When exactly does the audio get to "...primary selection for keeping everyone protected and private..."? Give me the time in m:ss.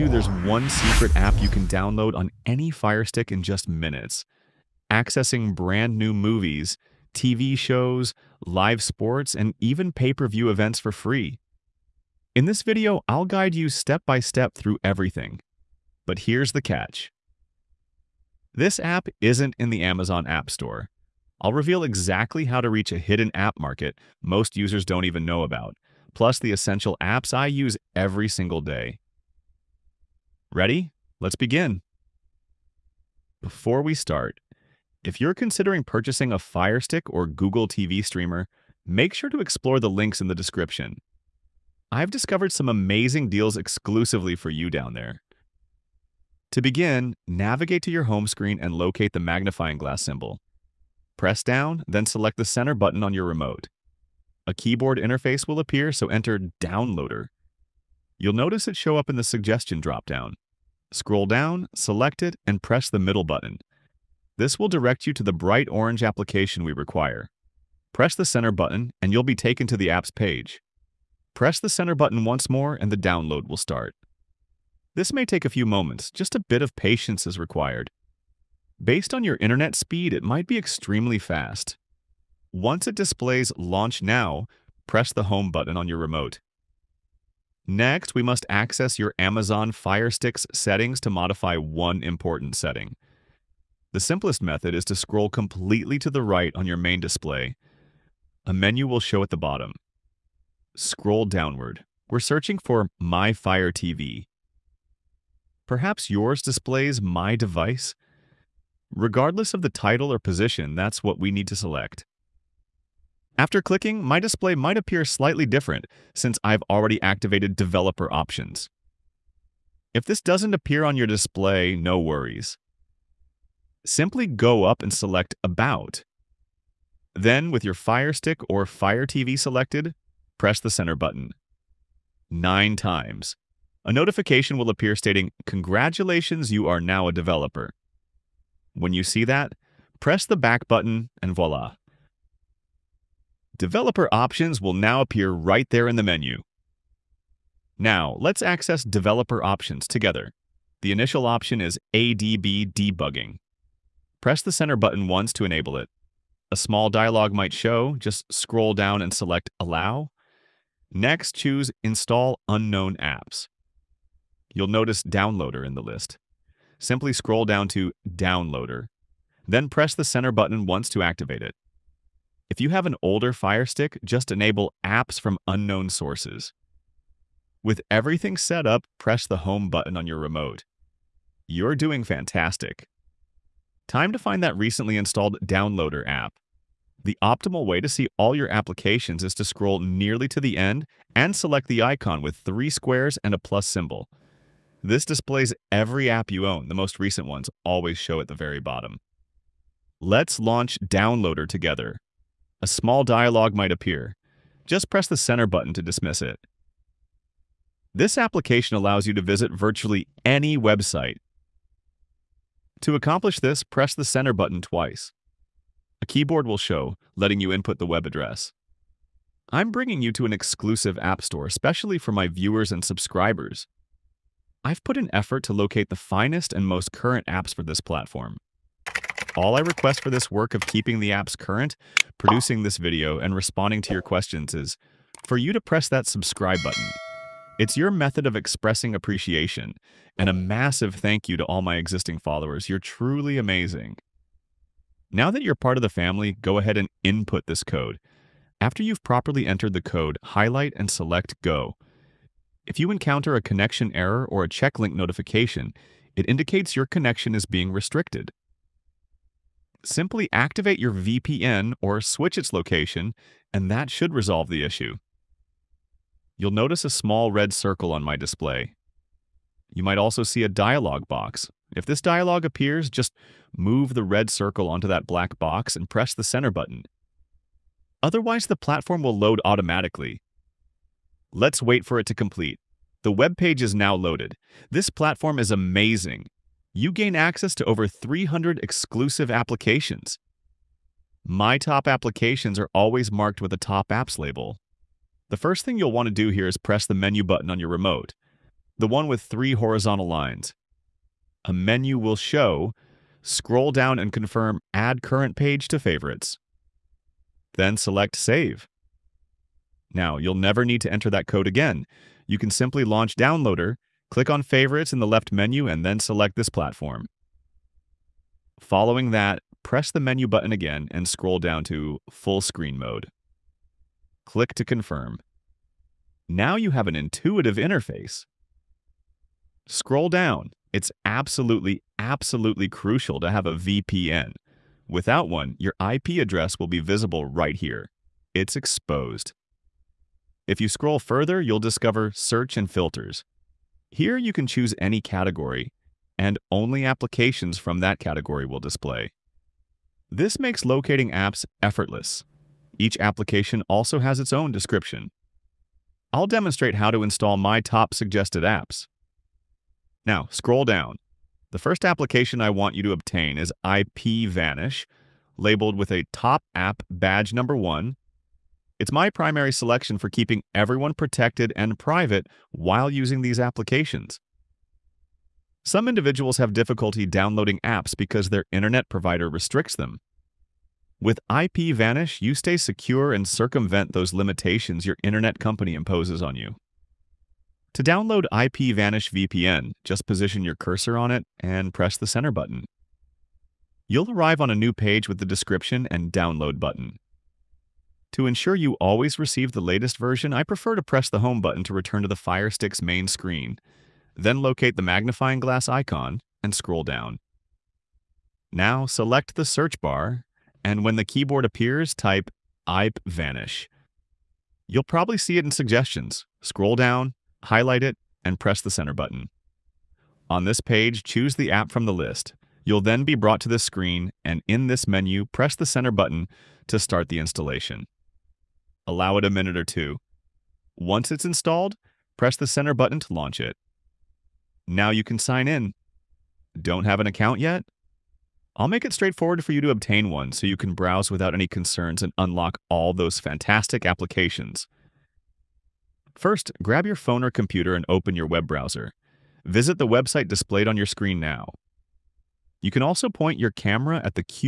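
6:09.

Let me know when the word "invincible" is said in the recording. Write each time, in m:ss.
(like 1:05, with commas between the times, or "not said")
not said.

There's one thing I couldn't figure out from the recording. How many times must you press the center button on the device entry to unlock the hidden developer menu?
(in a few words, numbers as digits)
9 times.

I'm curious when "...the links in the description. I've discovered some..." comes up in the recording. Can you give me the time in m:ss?
0:39.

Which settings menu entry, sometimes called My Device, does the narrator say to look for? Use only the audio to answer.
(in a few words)
My Fire TV.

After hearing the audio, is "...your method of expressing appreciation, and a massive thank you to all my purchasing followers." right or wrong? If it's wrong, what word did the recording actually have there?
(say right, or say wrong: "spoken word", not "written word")
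wrong: "existing", not "purchasing".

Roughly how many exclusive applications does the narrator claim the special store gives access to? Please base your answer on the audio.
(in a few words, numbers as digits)
over 300.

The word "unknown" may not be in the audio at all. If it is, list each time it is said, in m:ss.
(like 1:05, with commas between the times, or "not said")
2:42, 2:55.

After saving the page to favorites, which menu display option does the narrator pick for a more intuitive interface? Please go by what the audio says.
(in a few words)
Full Screen Mode.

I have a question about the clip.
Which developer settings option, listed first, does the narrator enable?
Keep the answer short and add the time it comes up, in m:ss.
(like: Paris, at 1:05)
ADB debugging, at 2:31.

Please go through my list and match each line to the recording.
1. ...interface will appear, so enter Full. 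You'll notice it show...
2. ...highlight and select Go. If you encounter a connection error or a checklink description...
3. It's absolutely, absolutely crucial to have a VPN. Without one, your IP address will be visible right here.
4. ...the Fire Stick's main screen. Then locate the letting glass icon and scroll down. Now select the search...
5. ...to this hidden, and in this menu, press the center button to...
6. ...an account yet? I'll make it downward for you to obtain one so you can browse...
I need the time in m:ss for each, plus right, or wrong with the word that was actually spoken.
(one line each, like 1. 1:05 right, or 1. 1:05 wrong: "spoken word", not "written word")
1. 0:54 wrong: "Downloader", not "Full"
2. 4:10 wrong: "notification", not "description"
3. 5:30 right
4. 6:42 wrong: "magnifying", not "letting"
5. 7:03 wrong: "screen", not "hidden"
6. 7:17 wrong: "straightforward", not "downward".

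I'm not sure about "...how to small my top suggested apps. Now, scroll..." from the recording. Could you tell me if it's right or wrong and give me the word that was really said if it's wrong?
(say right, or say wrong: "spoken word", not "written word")
wrong: "install", not "small".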